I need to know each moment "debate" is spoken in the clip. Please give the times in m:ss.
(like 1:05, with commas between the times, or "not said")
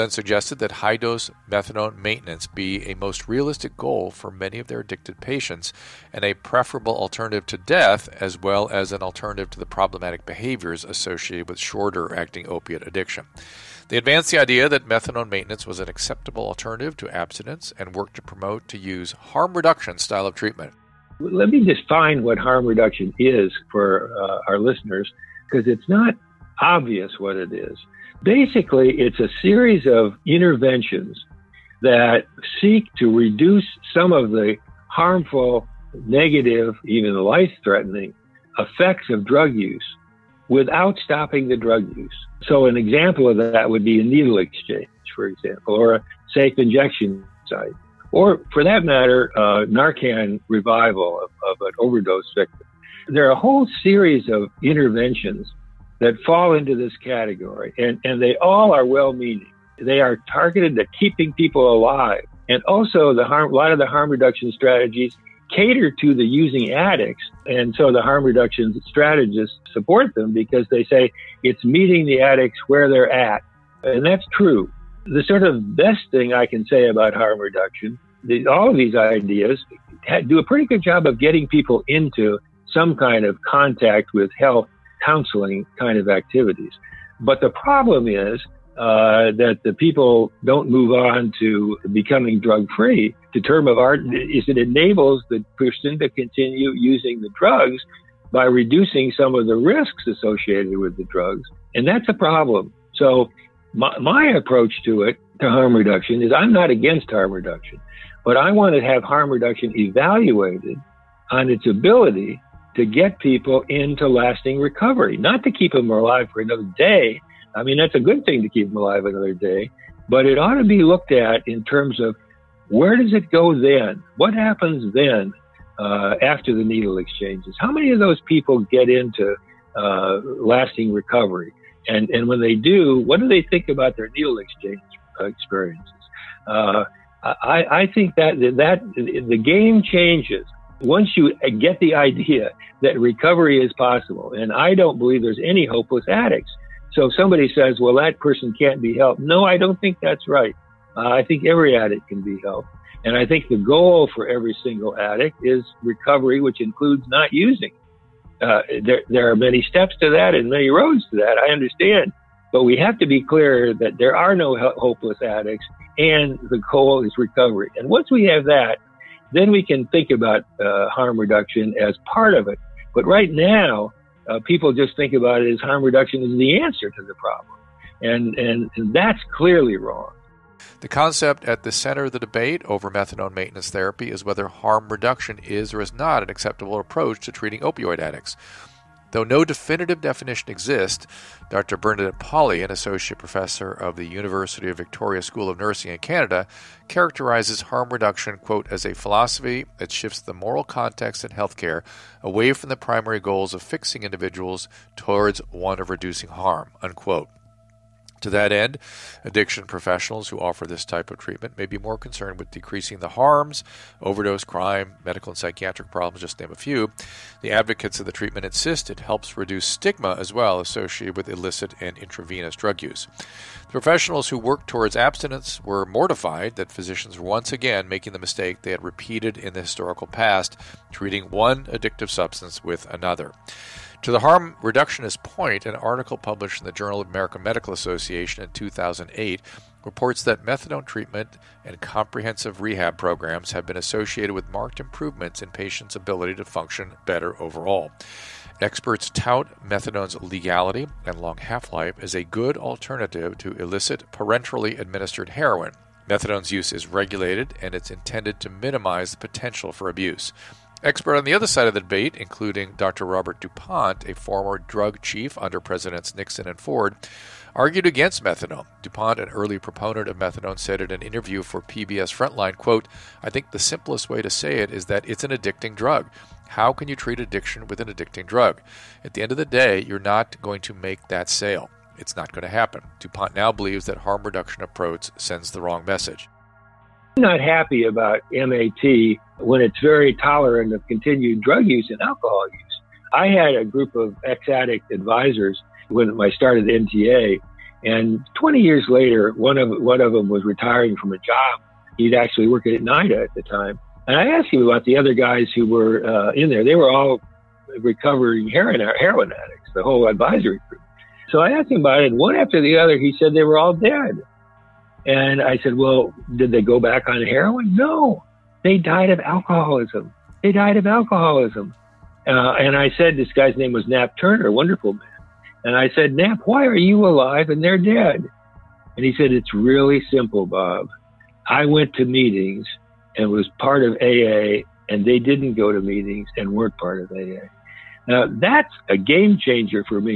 3:02, 4:21.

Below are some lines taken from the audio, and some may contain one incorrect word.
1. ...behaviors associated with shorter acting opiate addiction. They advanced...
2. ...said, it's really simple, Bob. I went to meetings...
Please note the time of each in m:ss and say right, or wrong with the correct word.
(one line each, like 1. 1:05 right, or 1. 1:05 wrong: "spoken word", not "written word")
1. 0:10 right
2. 5:29 right.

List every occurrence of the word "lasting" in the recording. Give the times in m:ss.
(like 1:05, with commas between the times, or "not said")
1:54, 2:10.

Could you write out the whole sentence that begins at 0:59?
They are targeted at keeping people alive.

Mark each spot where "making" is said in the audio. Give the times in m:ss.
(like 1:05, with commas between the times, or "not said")
3:47.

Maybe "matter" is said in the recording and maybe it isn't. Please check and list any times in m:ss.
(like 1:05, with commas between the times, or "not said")
0:48.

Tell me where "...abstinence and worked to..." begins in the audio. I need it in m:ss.
0:17.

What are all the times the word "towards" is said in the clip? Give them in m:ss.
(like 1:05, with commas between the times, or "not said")
3:24, 3:44.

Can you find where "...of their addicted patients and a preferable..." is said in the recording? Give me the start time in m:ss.
0:04.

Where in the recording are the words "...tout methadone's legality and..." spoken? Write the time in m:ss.
4:09.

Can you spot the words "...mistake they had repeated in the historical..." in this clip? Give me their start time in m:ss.
3:48.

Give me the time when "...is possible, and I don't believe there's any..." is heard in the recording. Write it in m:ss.
2:23.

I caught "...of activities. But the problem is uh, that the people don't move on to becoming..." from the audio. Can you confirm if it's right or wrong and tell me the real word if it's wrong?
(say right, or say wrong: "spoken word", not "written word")
right.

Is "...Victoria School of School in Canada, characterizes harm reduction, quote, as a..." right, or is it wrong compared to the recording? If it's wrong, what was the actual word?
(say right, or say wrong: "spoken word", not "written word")
wrong: "Nursing", not "School".